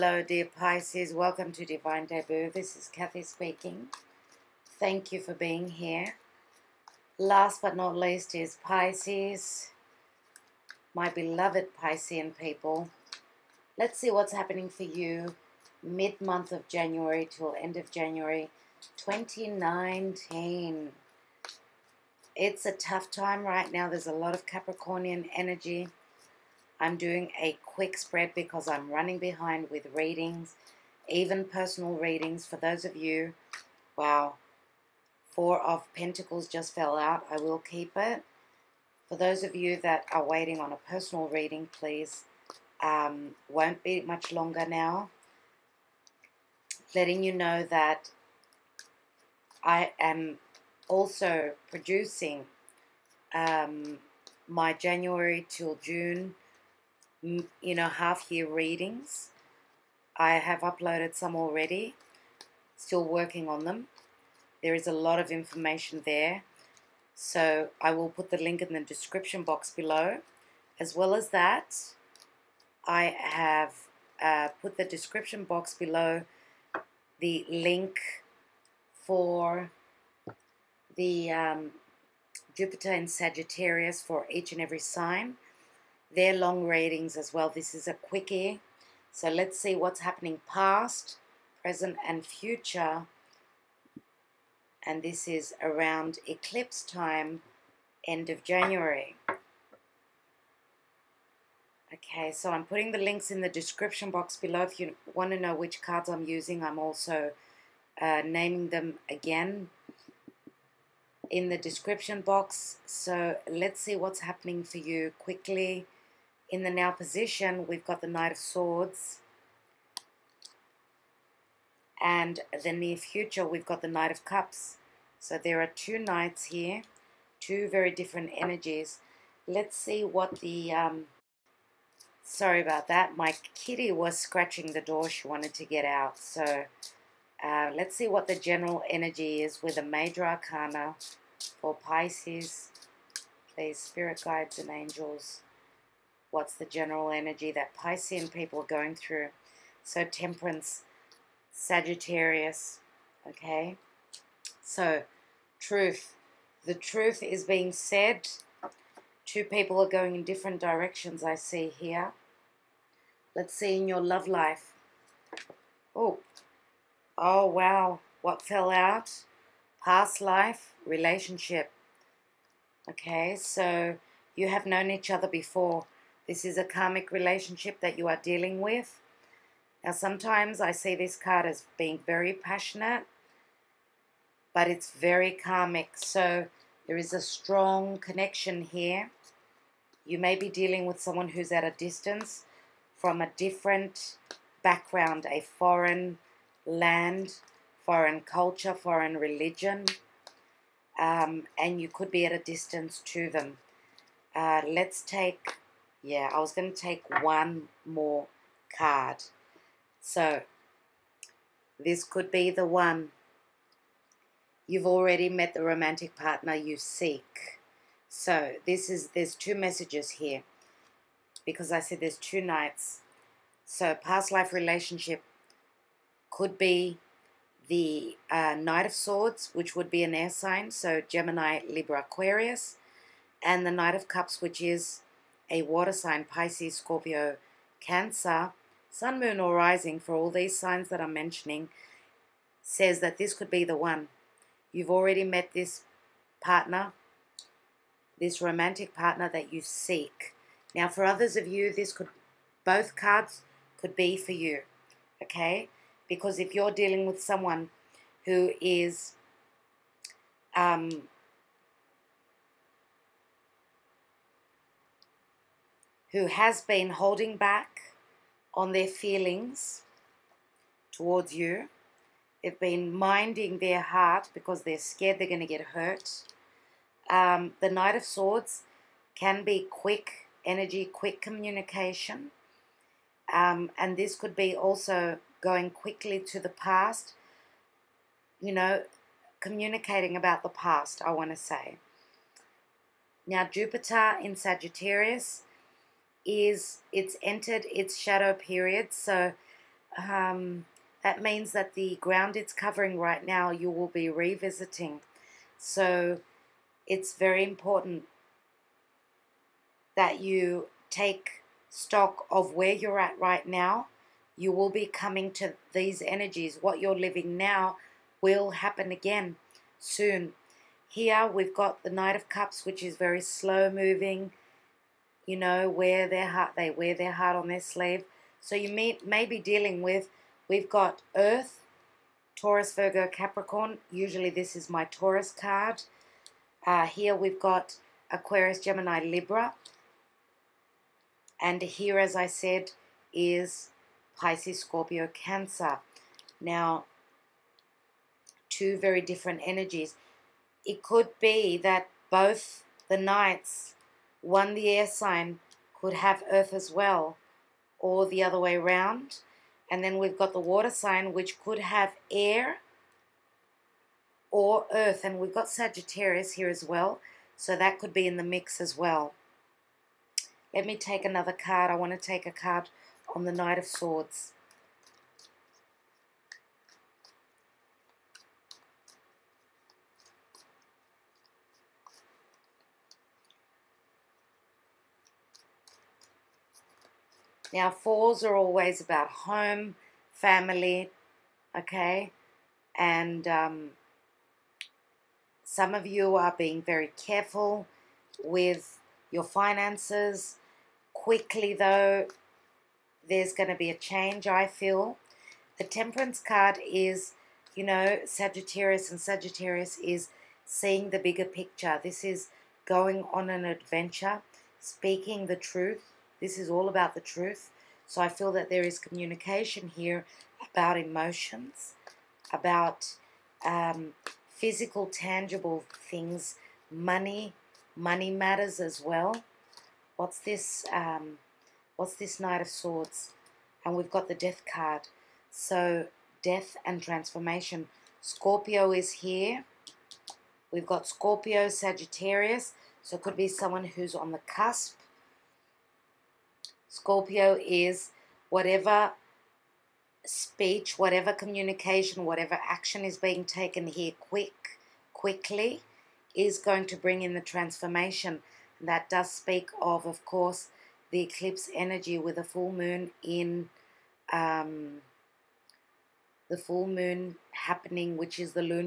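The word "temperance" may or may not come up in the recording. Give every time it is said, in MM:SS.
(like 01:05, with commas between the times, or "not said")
02:30, 06:45.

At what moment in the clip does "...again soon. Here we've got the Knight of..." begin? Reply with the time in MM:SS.
05:18.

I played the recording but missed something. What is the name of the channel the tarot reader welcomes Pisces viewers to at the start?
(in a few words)
Divine Debut.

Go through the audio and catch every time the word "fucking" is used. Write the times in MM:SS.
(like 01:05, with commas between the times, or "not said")
not said.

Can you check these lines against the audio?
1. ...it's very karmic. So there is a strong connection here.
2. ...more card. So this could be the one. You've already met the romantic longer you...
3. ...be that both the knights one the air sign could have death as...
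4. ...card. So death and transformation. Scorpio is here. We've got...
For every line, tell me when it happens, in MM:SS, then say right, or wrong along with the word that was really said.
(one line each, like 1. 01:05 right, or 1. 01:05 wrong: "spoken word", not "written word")
1. 03:04 right
2. 03:27 wrong: "partner", not "longer"
3. 05:51 wrong: "earth", not "death"
4. 07:14 right.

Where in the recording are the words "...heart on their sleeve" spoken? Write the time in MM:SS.
05:27.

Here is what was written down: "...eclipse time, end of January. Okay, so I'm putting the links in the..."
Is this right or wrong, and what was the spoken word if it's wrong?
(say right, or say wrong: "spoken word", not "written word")
right.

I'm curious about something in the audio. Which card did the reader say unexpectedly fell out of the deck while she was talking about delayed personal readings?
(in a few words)
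Four of Pentacles.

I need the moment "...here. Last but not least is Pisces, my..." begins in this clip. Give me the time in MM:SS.
00:05.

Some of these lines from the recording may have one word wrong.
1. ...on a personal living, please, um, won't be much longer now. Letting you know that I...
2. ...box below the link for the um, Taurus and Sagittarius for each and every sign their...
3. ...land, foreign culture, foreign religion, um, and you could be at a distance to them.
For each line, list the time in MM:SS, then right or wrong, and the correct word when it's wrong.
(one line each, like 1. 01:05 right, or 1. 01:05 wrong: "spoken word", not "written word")
1. 00:40 wrong: "reading", not "living"
2. 01:15 wrong: "Jupiter", not "Taurus"
3. 03:16 right.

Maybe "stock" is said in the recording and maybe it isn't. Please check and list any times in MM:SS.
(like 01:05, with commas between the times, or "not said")
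05:11.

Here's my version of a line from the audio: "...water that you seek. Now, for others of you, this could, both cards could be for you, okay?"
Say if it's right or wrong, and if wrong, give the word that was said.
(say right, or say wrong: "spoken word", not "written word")
wrong: "partner", not "water".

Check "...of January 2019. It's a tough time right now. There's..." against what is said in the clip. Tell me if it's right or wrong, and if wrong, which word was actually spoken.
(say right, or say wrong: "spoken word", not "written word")
right.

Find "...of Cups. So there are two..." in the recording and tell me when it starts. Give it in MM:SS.
02:04.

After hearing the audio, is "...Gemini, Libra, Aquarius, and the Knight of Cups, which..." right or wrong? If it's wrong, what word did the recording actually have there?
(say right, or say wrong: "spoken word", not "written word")
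right.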